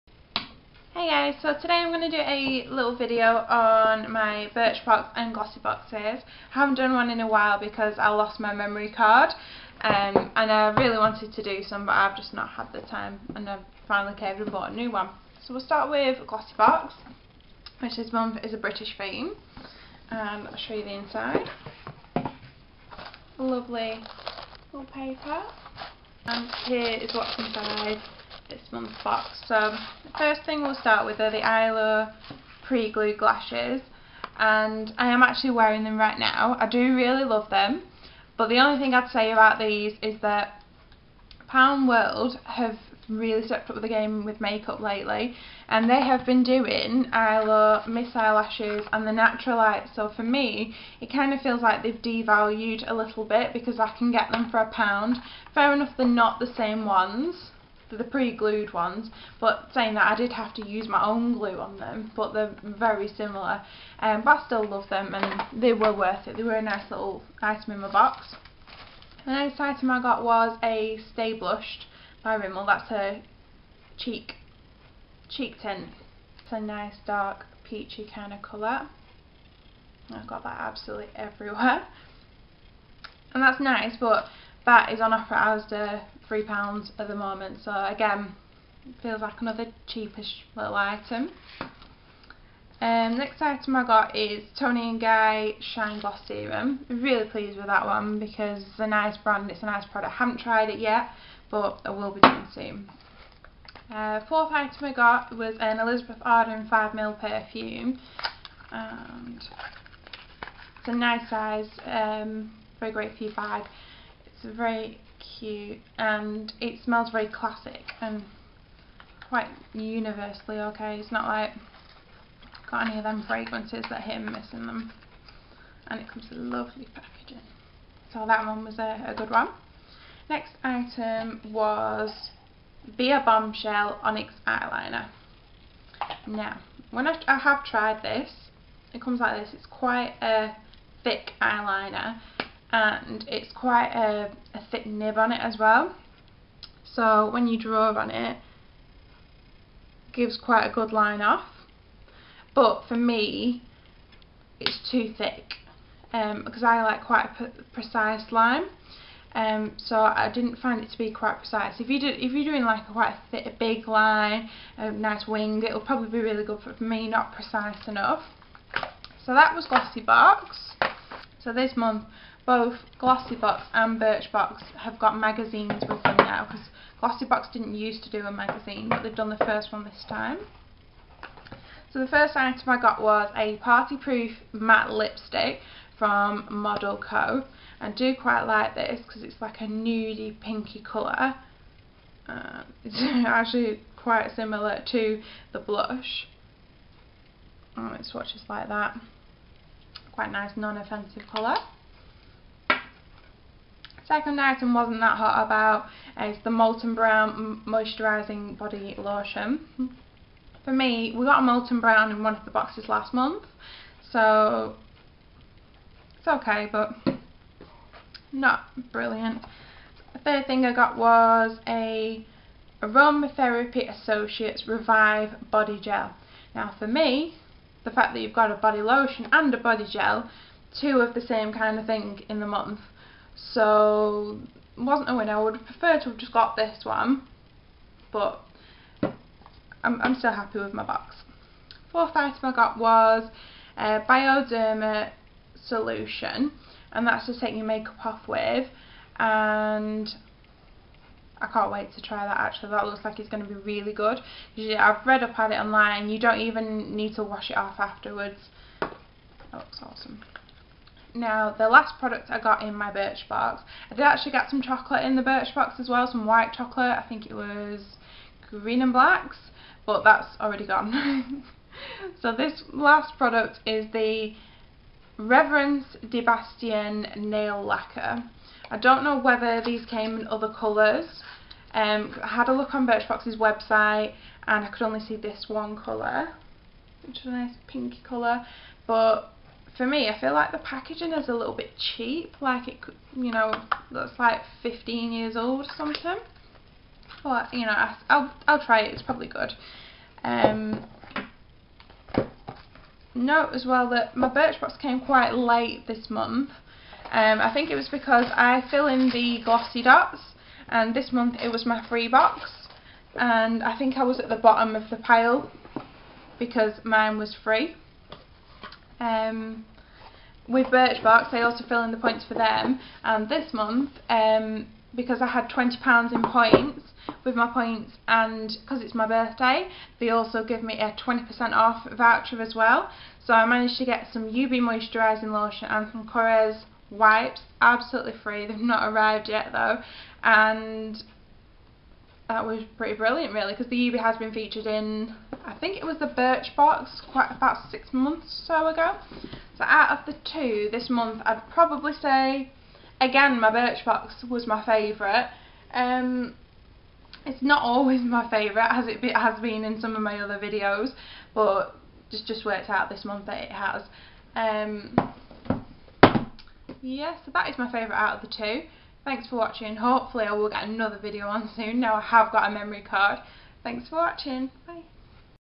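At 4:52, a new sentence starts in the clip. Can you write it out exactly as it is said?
Like it, you know, looks like 15 years old or something.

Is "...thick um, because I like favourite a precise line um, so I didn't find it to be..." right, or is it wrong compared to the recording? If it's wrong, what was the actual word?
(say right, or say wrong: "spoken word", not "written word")
wrong: "quite", not "favourite".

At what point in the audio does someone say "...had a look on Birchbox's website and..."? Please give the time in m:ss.
4:42.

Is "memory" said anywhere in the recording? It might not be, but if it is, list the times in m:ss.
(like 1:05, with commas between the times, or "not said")
0:08, 6:12.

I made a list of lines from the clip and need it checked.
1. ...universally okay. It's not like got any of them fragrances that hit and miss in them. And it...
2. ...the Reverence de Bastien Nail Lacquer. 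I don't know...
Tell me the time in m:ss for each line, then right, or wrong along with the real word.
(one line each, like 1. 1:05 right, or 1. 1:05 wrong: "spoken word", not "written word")
1. 1:59 right
2. 4:33 right.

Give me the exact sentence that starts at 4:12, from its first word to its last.
That looks like it's going to be really good.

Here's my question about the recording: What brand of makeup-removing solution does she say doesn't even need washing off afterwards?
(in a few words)
Bioderma.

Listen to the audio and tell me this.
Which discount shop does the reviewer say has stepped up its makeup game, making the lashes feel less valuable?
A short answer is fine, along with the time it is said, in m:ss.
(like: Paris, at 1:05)
Pound World, at 0:41.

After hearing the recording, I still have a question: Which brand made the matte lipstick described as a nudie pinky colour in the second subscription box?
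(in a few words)
Model Co.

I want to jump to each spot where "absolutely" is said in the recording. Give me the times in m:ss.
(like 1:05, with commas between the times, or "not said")
1:20, 5:37.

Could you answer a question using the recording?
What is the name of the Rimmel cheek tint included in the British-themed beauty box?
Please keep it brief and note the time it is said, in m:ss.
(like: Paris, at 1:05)
Stay Blushed, at 1:11.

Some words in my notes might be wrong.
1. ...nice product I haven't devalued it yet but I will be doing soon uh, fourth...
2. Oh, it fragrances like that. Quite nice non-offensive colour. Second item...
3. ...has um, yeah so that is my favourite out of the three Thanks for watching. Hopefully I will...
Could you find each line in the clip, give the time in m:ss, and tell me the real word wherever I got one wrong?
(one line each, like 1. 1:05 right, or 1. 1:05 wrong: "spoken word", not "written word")
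1. 1:39 wrong: "tried", not "devalued"
2. 3:17 wrong: "swatches", not "fragrances"
3. 6:03 wrong: "two", not "three".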